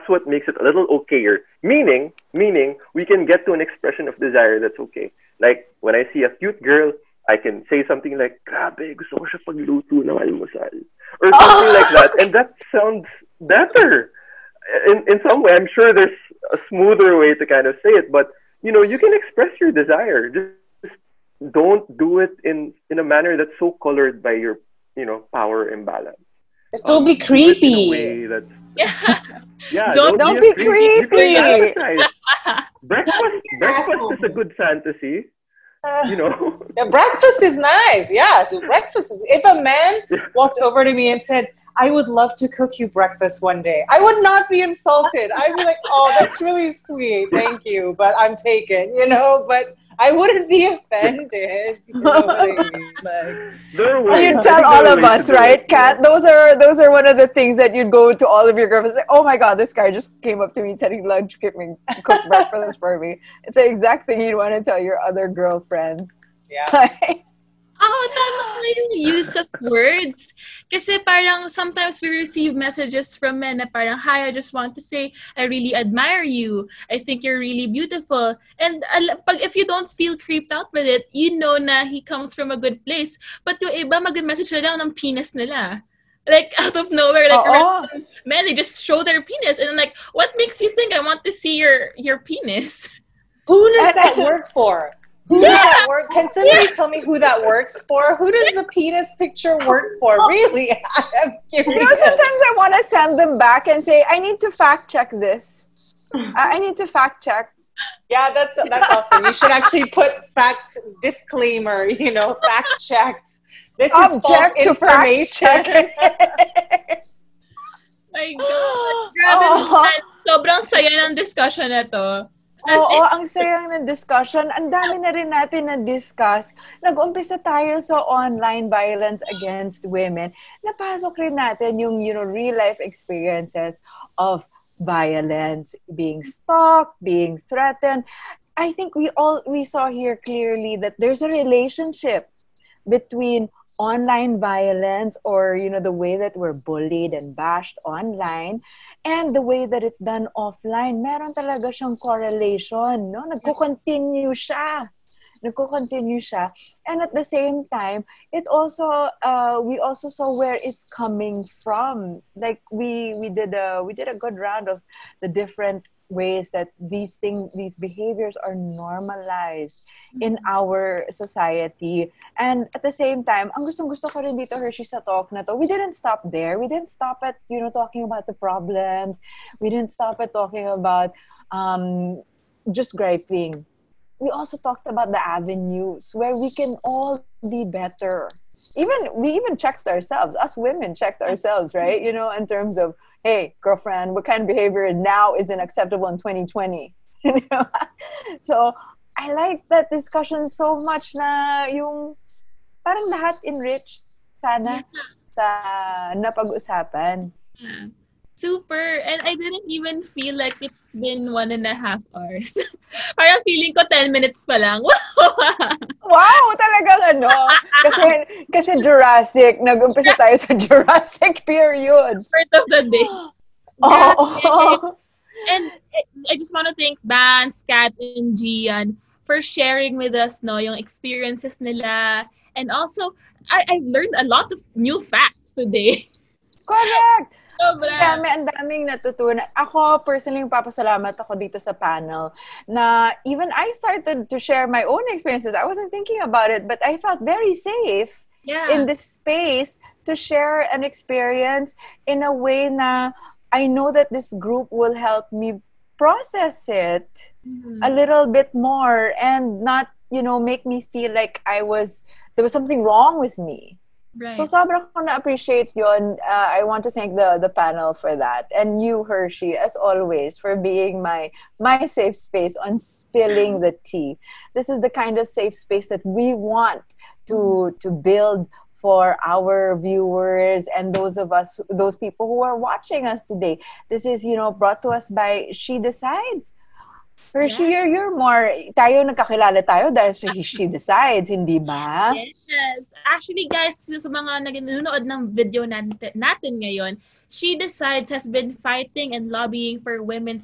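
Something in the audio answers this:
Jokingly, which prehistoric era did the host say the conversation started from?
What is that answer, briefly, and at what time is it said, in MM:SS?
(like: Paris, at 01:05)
Jurassic period, at 03:40.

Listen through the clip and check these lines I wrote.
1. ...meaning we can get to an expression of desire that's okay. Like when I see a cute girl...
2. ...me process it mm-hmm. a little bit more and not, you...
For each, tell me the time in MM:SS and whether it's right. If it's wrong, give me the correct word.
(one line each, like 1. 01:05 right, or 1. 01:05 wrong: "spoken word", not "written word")
1. 00:02 right
2. 04:15 right.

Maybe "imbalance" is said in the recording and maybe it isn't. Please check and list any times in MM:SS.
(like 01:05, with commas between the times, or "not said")
00:25.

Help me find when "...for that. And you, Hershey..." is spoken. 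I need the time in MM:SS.
04:27.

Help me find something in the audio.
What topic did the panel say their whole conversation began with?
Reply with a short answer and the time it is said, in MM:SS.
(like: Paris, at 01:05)
Online violence against women, at 02:08.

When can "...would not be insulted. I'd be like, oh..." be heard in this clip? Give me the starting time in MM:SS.
00:44.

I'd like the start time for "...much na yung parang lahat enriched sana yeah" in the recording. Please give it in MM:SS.
03:20.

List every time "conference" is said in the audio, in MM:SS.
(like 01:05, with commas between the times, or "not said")
not said.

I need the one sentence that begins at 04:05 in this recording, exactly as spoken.
I wasn't thinking about it, but I felt very safe yeah.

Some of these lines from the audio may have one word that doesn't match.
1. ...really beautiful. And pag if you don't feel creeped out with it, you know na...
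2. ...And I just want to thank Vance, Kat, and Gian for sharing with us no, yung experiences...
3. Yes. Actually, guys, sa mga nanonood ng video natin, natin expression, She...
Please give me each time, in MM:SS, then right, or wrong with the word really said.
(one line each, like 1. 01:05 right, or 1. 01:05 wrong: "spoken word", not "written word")
1. 01:17 right
2. 03:45 right
3. 04:52 wrong: "ngayon", not "expression".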